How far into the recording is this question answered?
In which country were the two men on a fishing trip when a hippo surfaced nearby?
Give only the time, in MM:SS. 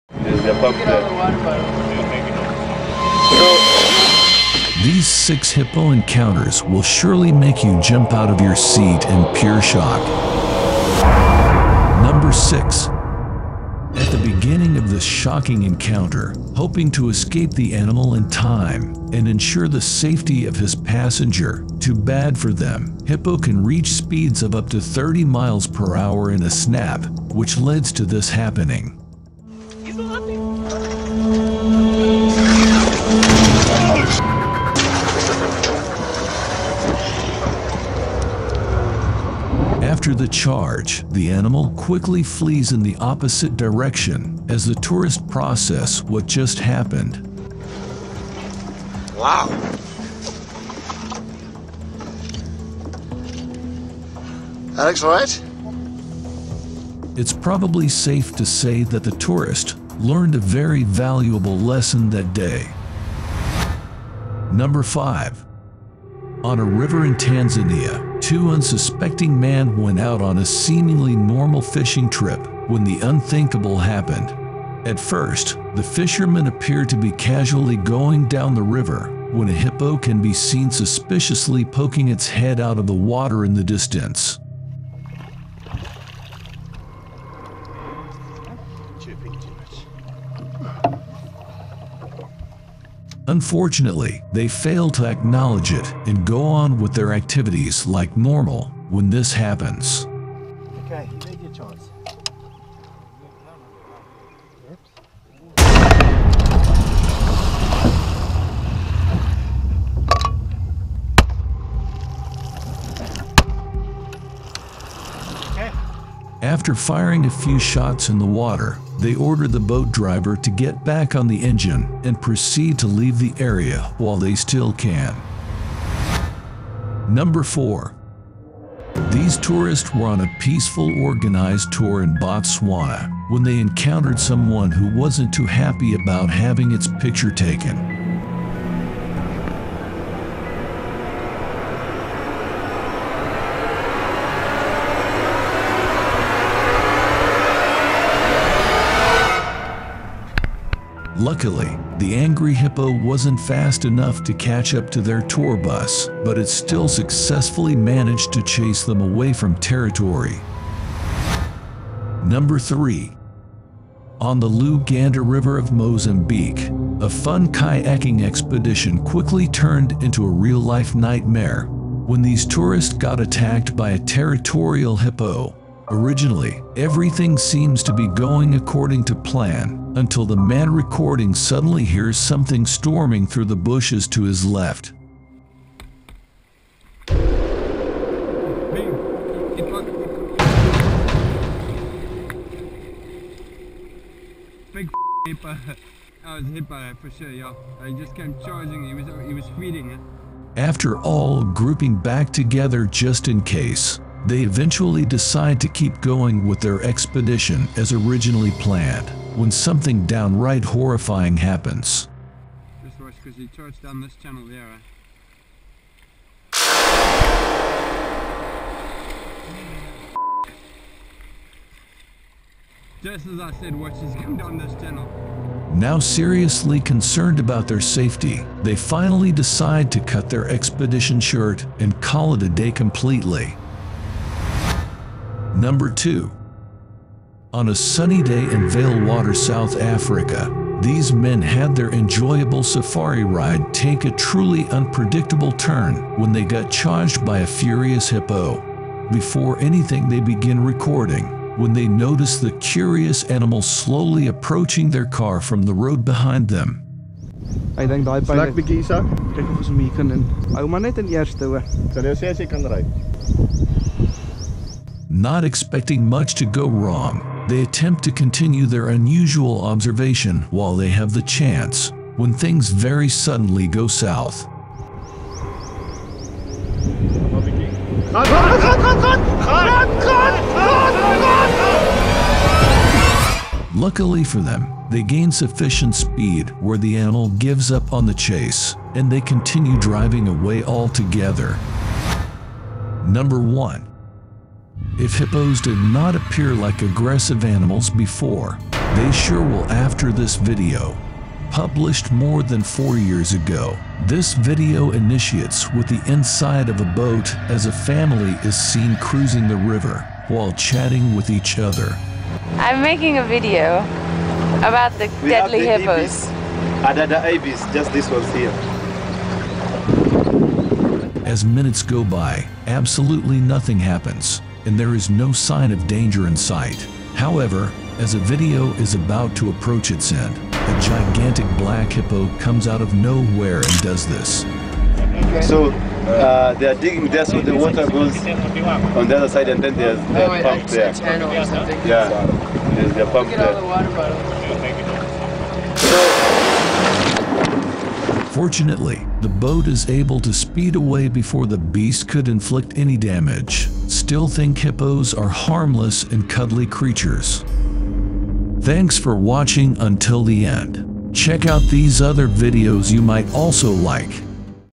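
01:07.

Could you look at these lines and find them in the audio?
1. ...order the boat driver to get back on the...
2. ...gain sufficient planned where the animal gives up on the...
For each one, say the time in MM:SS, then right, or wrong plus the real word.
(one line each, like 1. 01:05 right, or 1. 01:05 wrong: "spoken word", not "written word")
1. 01:59 right
2. 04:45 wrong: "speed", not "planned".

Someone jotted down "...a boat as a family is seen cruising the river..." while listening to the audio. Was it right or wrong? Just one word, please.
right.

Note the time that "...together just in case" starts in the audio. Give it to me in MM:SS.
03:22.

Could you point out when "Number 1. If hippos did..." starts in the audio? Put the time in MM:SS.
04:53.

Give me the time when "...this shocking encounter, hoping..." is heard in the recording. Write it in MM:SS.
00:14.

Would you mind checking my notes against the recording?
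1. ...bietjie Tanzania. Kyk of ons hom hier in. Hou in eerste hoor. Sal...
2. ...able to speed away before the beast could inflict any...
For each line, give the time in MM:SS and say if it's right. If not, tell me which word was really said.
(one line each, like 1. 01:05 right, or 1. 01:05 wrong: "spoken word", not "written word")
1. 04:18 wrong: "Isak", not "Tanzania"
2. 05:49 right.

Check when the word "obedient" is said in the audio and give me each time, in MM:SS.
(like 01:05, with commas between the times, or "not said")
not said.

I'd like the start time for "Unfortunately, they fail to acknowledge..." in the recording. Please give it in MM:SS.
01:33.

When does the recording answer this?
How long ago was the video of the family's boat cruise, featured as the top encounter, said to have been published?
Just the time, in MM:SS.
05:02.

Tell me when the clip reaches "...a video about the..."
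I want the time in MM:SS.
05:13.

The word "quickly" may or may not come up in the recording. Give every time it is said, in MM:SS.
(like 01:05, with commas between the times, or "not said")
00:41, 02:49.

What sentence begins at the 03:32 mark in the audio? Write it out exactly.
Just watch because he turns down this channel there.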